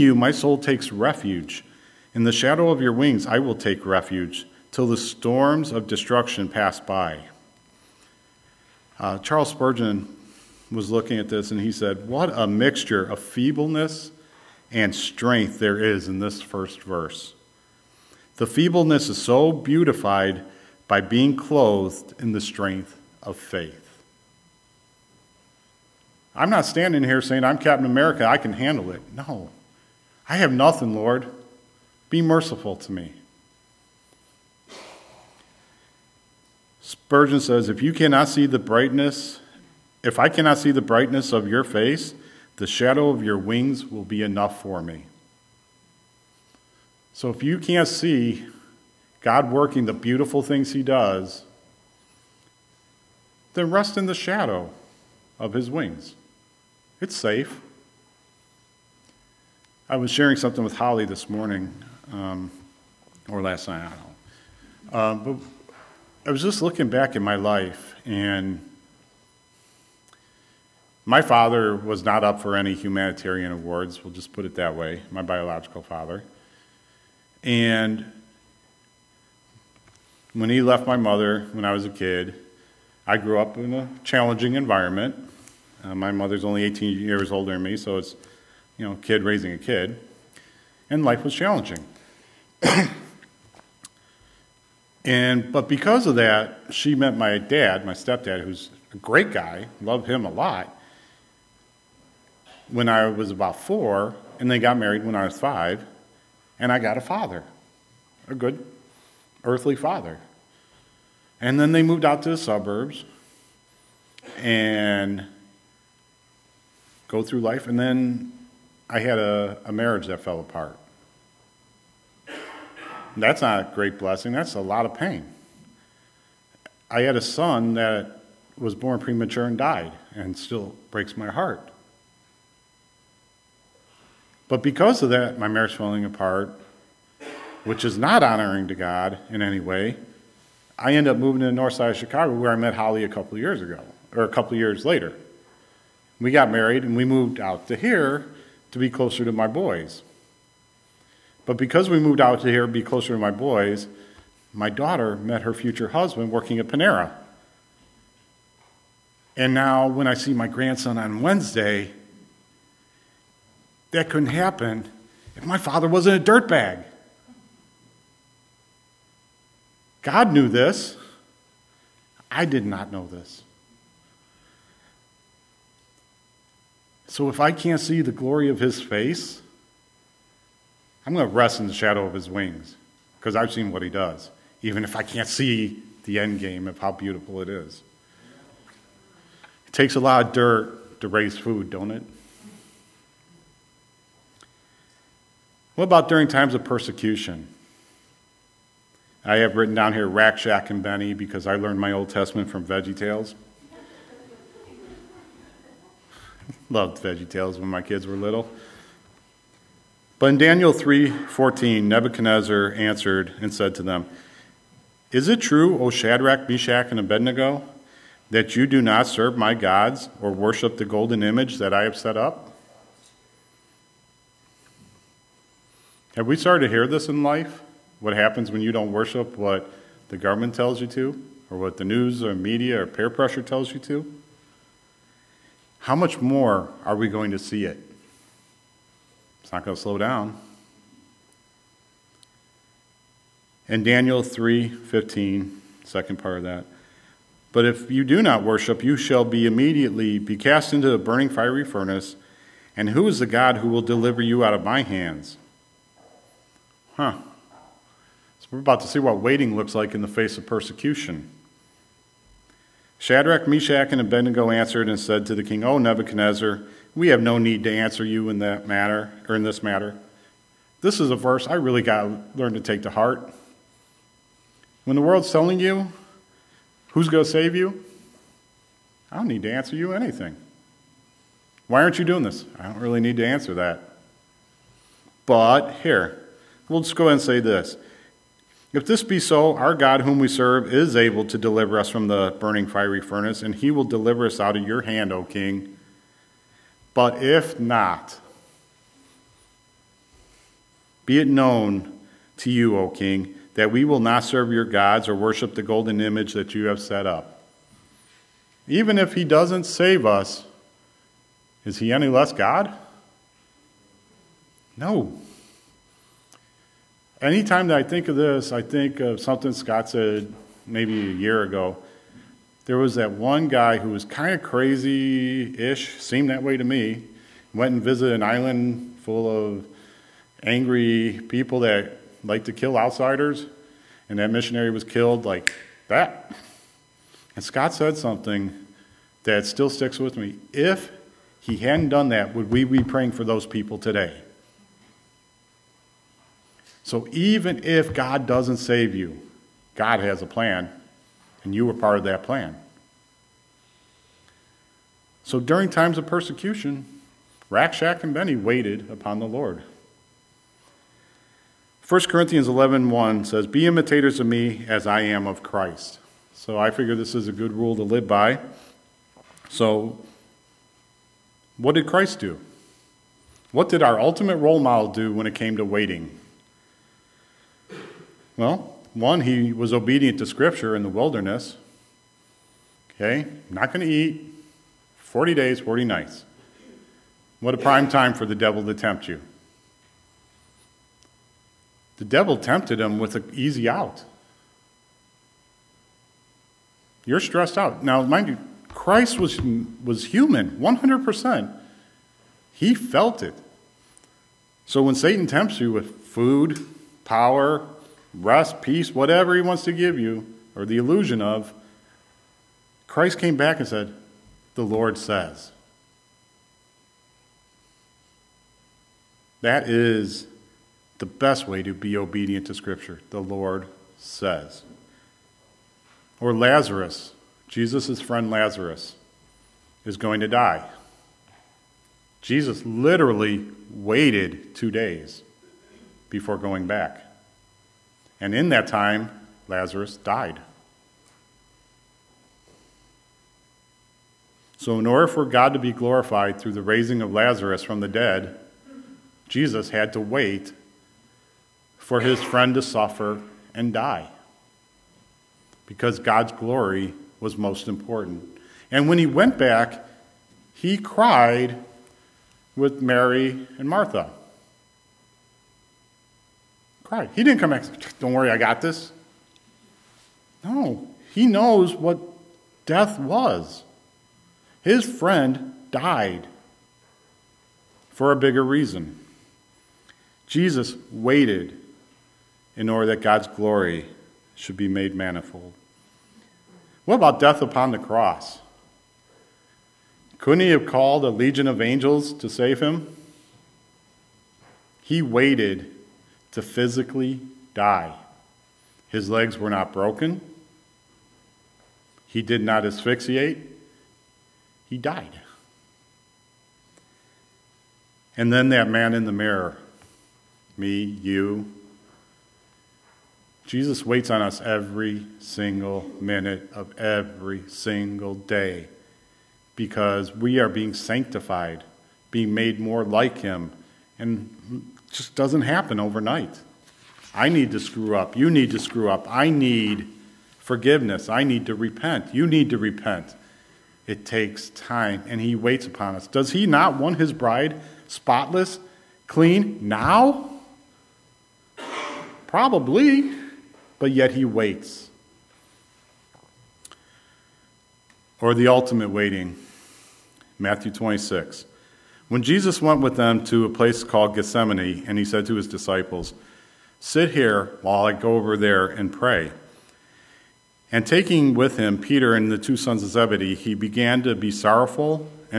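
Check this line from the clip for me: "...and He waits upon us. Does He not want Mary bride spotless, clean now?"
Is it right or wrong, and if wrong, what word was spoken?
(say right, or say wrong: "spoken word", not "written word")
wrong: "His", not "Mary".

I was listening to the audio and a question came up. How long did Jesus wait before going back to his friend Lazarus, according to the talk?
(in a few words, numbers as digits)
2 days.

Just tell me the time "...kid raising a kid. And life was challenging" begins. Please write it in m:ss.
1:29.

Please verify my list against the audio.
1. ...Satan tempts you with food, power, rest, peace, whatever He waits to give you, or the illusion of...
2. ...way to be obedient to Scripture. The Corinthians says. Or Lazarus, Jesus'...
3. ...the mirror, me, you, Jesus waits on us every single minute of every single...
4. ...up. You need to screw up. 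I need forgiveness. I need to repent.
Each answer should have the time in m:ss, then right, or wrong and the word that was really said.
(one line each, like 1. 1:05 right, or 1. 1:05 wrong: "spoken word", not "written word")
1. 6:44 wrong: "wants", not "waits"
2. 7:01 wrong: "Lord", not "Corinthians"
3. 8:29 right
4. 8:47 right.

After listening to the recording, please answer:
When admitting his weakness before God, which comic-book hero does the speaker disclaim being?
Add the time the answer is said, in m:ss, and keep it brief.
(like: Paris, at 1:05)
Captain America, at 0:27.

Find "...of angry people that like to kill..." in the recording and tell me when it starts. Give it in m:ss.
5:29.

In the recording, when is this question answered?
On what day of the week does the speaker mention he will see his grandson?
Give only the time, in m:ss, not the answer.
2:41.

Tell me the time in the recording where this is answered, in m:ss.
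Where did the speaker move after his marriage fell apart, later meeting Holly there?
2:21.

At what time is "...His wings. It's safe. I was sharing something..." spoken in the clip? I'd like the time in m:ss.
0:55.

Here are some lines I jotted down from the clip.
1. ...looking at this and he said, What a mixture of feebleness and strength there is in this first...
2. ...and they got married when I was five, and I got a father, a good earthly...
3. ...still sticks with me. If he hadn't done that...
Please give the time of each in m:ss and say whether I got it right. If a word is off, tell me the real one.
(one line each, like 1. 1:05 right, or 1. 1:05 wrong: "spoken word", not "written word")
1. 0:10 right
2. 1:44 right
3. 5:39 right.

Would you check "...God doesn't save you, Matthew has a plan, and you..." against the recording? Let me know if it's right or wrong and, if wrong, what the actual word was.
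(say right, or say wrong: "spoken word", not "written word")
wrong: "God", not "Matthew".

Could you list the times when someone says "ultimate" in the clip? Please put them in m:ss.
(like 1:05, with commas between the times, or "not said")
6:13, 9:08.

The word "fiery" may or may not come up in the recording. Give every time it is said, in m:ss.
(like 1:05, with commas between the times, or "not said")
4:11, 4:52.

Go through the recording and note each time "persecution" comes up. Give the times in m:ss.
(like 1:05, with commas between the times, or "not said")
3:16, 4:20, 5:56.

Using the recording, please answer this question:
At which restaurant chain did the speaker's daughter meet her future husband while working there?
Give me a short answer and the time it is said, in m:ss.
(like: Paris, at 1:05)
Panera, at 2:36.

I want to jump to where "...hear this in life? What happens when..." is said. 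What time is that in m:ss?
3:46.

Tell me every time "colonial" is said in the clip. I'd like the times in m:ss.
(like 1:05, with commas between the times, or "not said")
not said.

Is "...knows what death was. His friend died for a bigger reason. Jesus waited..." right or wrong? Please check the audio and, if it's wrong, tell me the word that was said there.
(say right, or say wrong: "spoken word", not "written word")
right.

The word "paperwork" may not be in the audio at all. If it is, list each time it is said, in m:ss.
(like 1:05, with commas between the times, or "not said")
not said.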